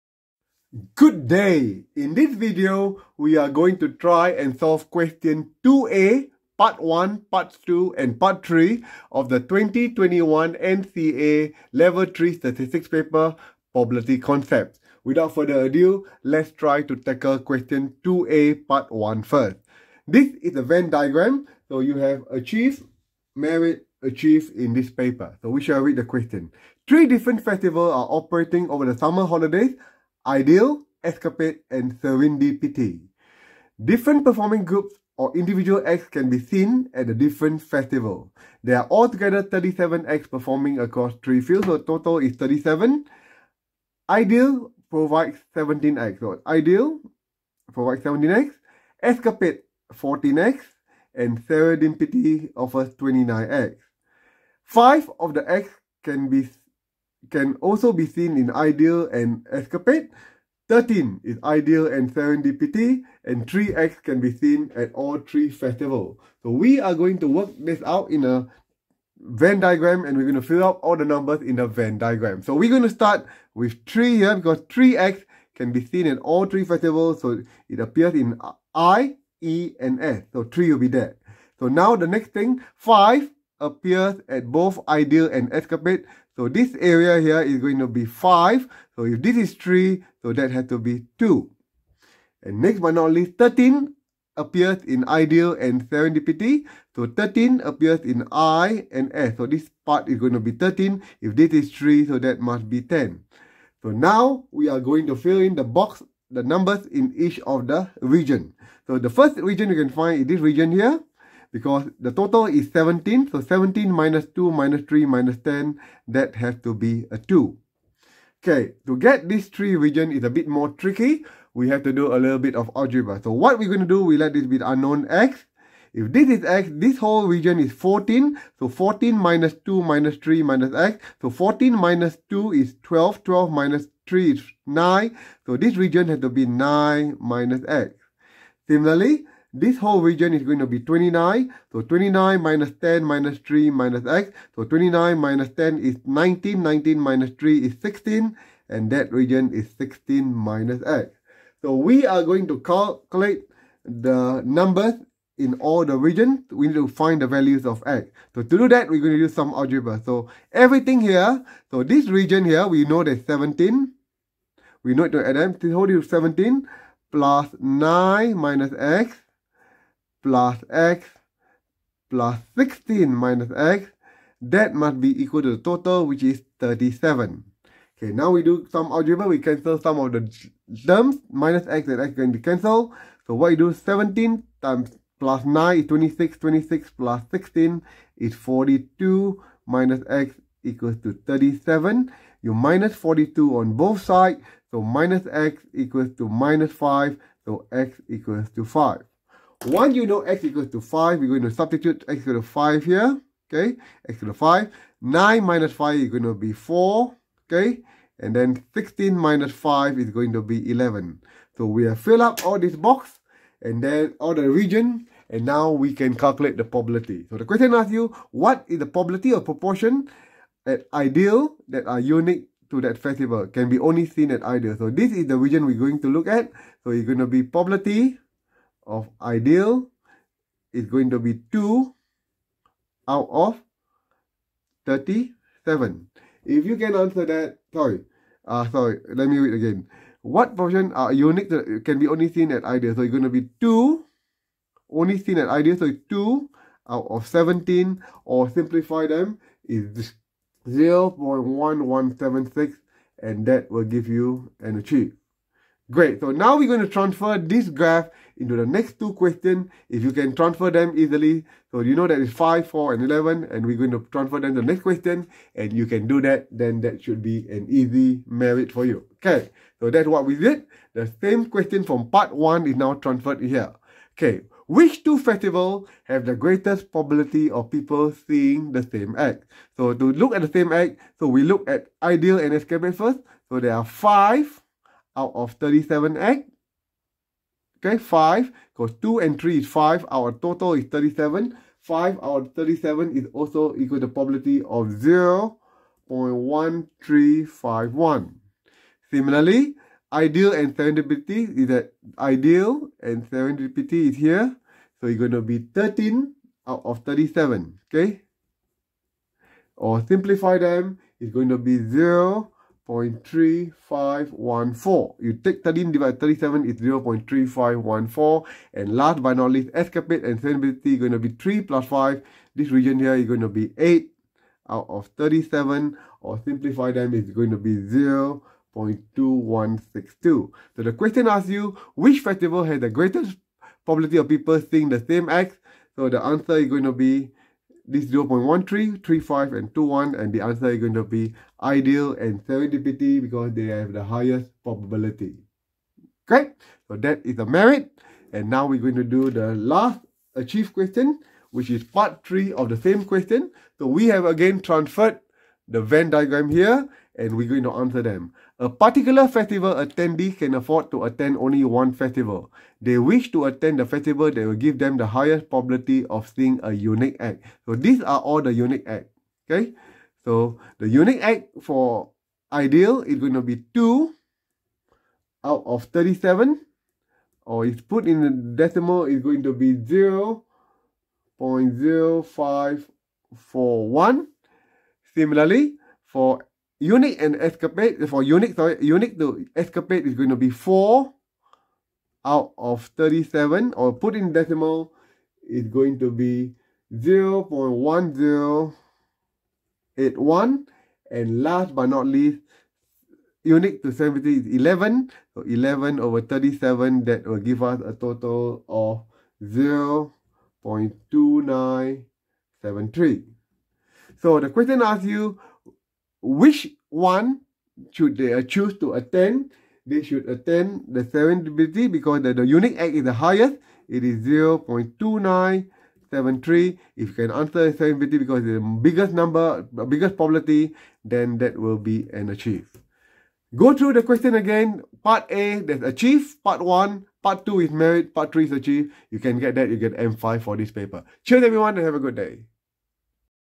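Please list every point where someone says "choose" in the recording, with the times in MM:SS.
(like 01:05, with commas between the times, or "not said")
06:58.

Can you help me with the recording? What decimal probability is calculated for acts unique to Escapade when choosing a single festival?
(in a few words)
0.1081.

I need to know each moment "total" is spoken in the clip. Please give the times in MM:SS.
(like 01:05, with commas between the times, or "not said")
00:41, 01:52, 02:55, 04:50, 06:47.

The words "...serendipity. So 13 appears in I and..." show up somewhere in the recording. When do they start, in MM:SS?
01:35.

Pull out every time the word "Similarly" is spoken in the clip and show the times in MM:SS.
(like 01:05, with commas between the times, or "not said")
02:18, 04:59, 06:25.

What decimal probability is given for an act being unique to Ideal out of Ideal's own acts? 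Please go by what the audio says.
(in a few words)
0.1176.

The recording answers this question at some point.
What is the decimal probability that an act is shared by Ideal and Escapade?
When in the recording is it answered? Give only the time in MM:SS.
04:55.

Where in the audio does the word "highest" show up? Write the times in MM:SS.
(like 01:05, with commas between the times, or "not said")
05:44, 06:05, 07:03.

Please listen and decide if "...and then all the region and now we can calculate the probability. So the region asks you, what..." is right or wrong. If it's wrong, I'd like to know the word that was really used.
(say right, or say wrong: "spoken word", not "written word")
wrong: "question", not "region".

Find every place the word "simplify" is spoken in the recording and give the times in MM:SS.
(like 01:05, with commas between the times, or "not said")
04:08, 05:10, 05:26.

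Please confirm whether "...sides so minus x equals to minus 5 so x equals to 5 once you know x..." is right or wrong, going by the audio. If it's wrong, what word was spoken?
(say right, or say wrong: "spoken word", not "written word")
right.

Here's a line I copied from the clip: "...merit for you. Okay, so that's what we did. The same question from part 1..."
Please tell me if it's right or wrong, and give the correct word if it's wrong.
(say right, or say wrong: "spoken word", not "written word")
right.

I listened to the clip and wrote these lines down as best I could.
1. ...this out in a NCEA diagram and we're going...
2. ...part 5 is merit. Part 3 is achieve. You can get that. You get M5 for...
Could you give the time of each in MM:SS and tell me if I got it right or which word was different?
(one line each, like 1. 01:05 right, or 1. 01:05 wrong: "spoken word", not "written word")
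1. 01:07 wrong: "Venn", not "NCEA"
2. 07:17 wrong: "2", not "5".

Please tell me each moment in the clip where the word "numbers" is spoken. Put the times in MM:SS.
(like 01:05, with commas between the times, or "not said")
01:11, 01:46, 02:34, 07:09.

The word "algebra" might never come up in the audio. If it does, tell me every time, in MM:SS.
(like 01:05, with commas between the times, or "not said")
02:02, 02:39, 02:58.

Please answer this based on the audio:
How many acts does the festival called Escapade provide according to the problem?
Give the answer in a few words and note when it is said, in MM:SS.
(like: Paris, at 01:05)
14, at 00:49.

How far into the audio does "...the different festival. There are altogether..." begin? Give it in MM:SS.
00:37.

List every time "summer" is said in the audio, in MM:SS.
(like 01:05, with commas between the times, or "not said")
00:28.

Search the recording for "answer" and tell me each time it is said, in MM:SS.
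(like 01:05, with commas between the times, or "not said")
03:56, 05:36, 05:40, 05:57, 07:07.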